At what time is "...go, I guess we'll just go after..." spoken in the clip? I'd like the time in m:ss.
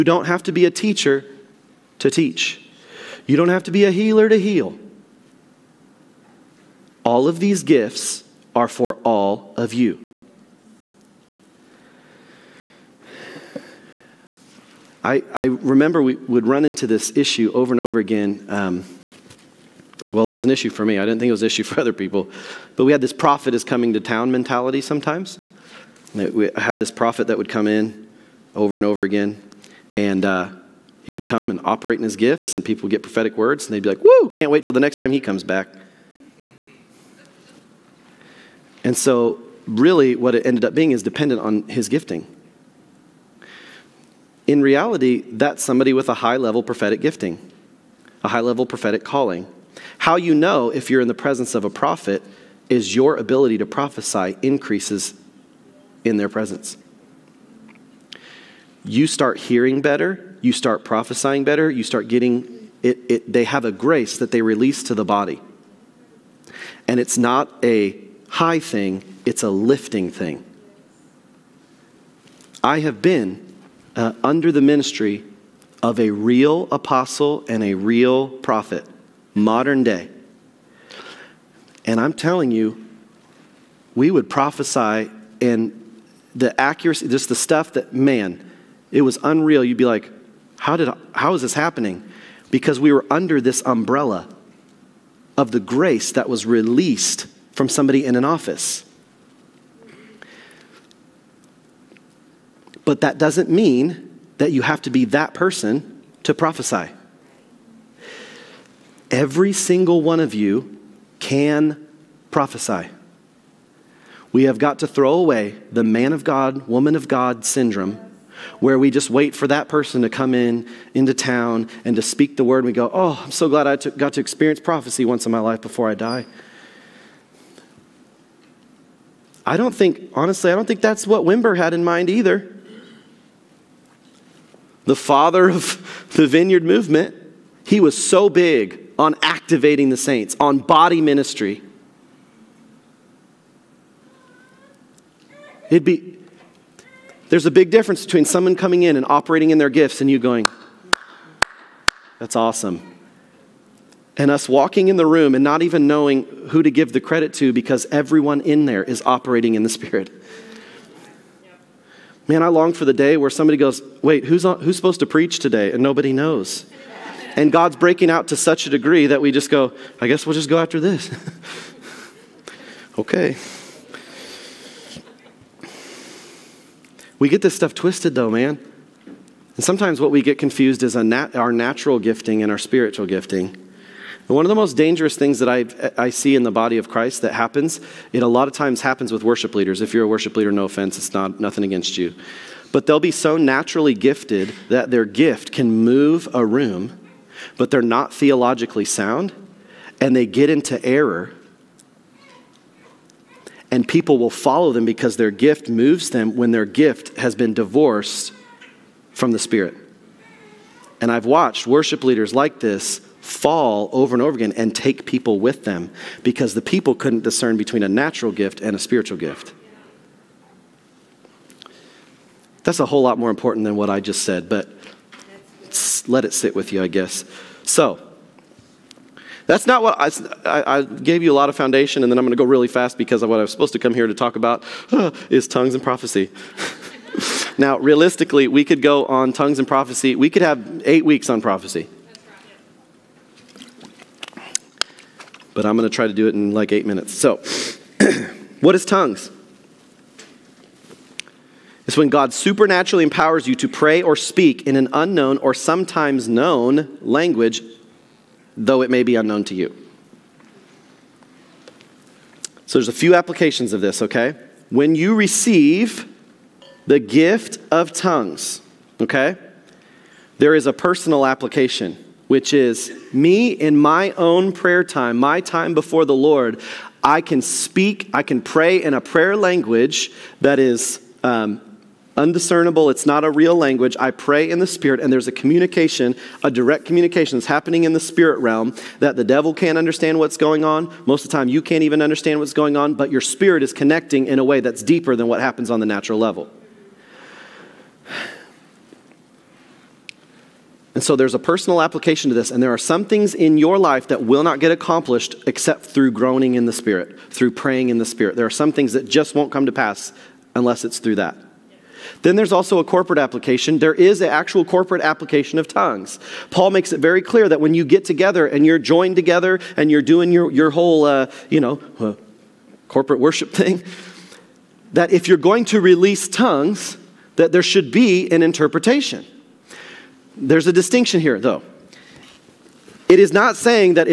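2:49.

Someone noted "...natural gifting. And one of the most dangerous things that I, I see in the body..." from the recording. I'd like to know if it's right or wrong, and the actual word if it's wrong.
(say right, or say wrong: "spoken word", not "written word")
wrong: "spiritual", not "natural".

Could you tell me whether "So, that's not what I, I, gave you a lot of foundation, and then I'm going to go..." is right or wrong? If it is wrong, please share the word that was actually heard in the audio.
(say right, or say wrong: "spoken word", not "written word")
right.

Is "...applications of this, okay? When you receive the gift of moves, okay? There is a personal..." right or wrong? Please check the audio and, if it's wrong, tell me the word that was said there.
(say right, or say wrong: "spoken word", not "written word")
wrong: "tongues", not "moves".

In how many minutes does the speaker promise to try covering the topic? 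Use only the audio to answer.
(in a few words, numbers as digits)
8.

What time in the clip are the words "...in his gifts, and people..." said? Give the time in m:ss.
0:31.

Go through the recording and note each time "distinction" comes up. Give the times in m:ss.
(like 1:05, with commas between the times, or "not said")
5:30.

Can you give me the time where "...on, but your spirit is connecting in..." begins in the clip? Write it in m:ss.
4:52.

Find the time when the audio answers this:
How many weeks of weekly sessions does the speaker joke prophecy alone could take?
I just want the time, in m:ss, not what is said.
4:00.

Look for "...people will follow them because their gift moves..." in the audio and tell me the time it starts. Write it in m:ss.
3:23.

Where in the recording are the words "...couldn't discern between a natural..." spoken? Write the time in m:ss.
3:36.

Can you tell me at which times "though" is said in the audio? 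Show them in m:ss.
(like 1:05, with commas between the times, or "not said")
2:58, 4:18, 5:31.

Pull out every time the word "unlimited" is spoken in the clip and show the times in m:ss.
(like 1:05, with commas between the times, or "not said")
not said.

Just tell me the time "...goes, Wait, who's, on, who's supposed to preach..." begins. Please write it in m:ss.
2:43.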